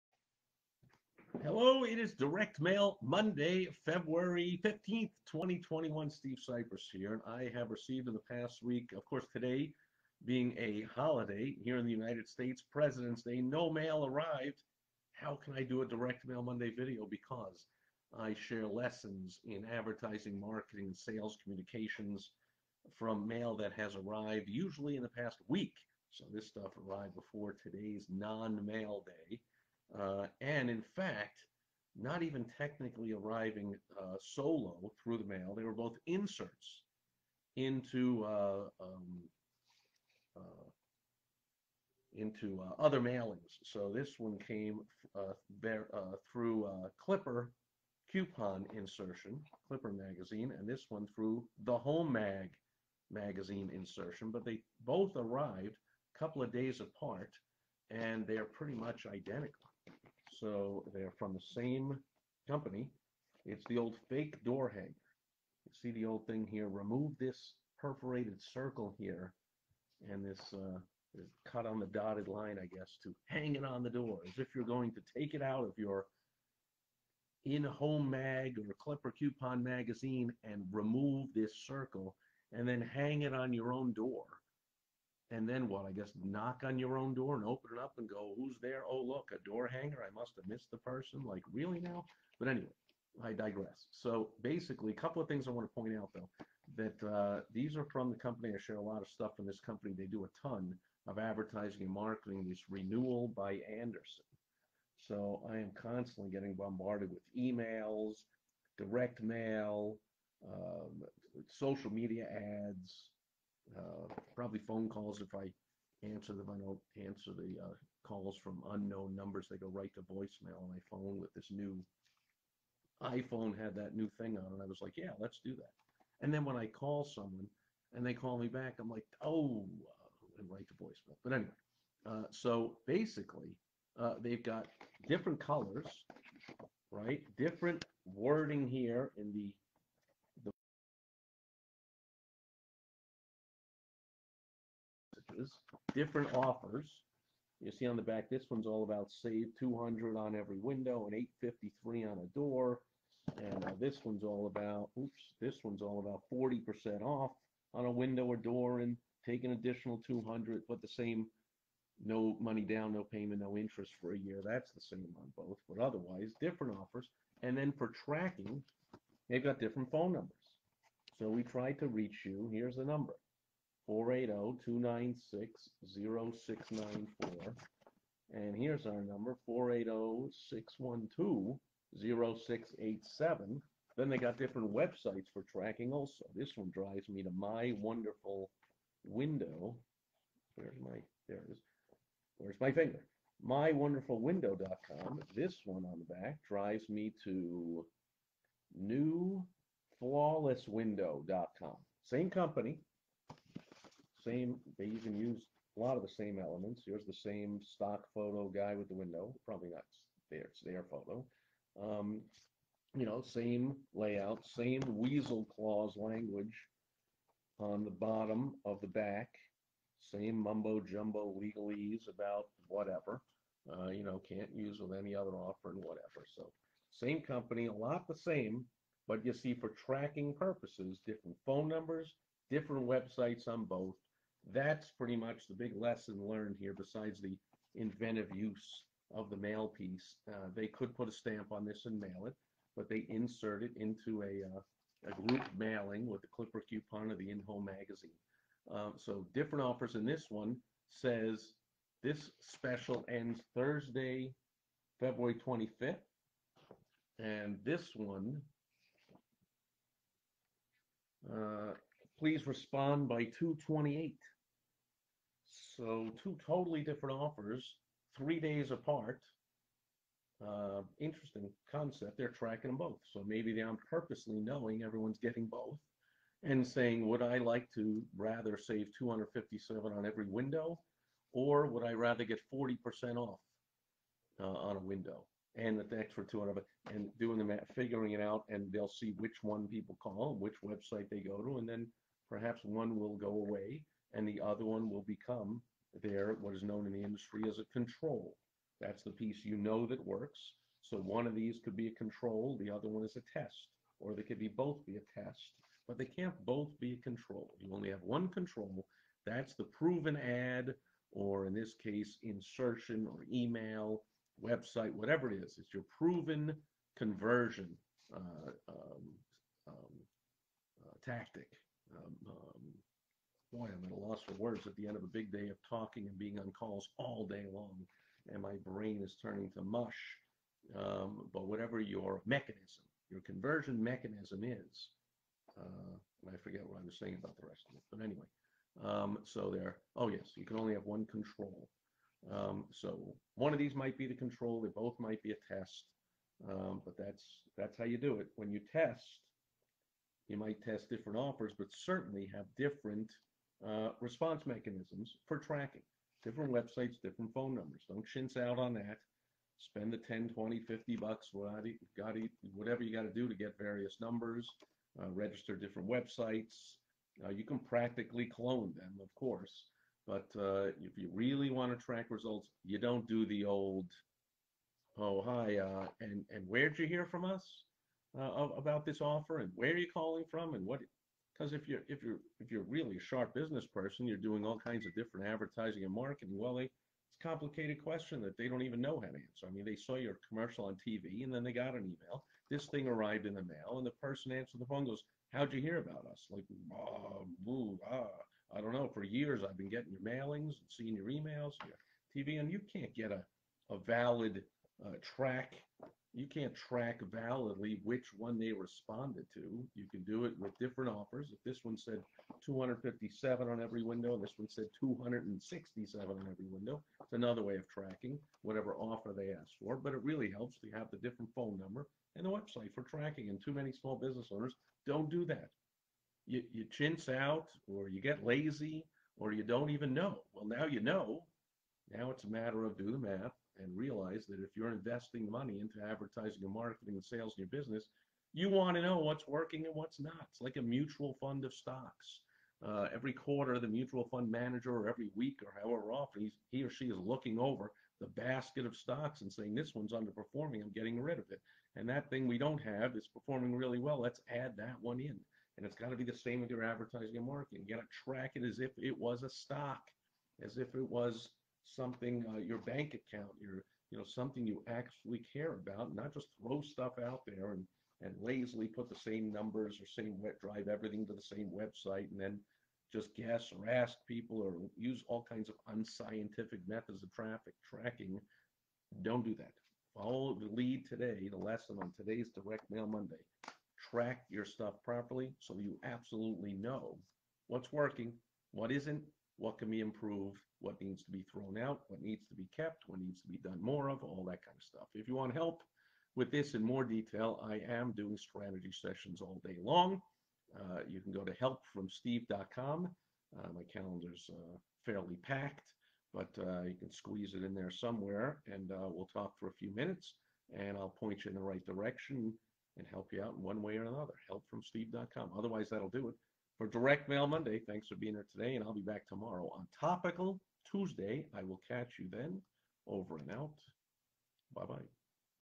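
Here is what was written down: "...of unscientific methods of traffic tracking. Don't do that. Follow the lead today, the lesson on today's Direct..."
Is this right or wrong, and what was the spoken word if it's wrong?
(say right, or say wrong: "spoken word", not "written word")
right.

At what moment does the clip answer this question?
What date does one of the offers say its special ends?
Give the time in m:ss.
4:13.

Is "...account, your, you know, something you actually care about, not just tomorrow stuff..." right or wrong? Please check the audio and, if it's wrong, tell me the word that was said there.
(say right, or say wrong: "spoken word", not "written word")
wrong: "throw", not "tomorrow".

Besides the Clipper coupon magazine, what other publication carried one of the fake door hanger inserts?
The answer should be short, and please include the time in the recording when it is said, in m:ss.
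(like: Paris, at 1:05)
Home Mag, at 0:51.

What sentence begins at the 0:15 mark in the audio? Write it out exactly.
How can I do a Direct Mail Monday video?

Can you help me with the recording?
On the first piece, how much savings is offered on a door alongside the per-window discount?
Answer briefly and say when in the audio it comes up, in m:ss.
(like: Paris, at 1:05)
$853, at 2:31.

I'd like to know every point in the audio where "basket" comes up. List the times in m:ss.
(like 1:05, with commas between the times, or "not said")
7:28.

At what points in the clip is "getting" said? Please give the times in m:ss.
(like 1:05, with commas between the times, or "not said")
1:46, 4:35, 6:39, 7:30.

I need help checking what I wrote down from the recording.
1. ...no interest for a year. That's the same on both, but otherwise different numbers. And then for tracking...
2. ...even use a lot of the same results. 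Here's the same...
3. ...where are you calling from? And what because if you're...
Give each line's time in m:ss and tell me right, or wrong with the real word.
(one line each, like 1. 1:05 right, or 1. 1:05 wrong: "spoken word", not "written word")
1. 2:43 wrong: "offers", not "numbers"
2. 3:24 wrong: "elements", not "results"
3. 6:19 right.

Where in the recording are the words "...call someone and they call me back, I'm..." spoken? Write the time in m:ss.
2:06.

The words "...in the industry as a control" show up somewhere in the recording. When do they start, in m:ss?
4:56.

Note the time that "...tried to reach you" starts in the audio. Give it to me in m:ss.
2:51.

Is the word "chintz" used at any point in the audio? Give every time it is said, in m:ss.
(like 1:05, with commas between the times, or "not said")
5:58, 7:06.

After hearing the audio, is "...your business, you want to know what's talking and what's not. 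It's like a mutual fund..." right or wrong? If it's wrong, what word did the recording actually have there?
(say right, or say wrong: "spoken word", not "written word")
wrong: "working", not "talking".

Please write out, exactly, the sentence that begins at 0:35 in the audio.
They were both inserts into uh, um, uh, into uh, other mailings.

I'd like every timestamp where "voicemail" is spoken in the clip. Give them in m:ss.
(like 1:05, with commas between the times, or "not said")
2:00, 2:10.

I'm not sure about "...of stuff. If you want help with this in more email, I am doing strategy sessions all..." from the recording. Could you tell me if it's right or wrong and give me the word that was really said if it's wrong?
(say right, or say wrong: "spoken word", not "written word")
wrong: "detail", not "email".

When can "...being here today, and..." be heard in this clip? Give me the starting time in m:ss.
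8:37.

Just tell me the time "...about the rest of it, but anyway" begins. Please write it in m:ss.
5:37.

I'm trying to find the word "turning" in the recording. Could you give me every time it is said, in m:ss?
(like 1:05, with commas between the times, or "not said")
5:29.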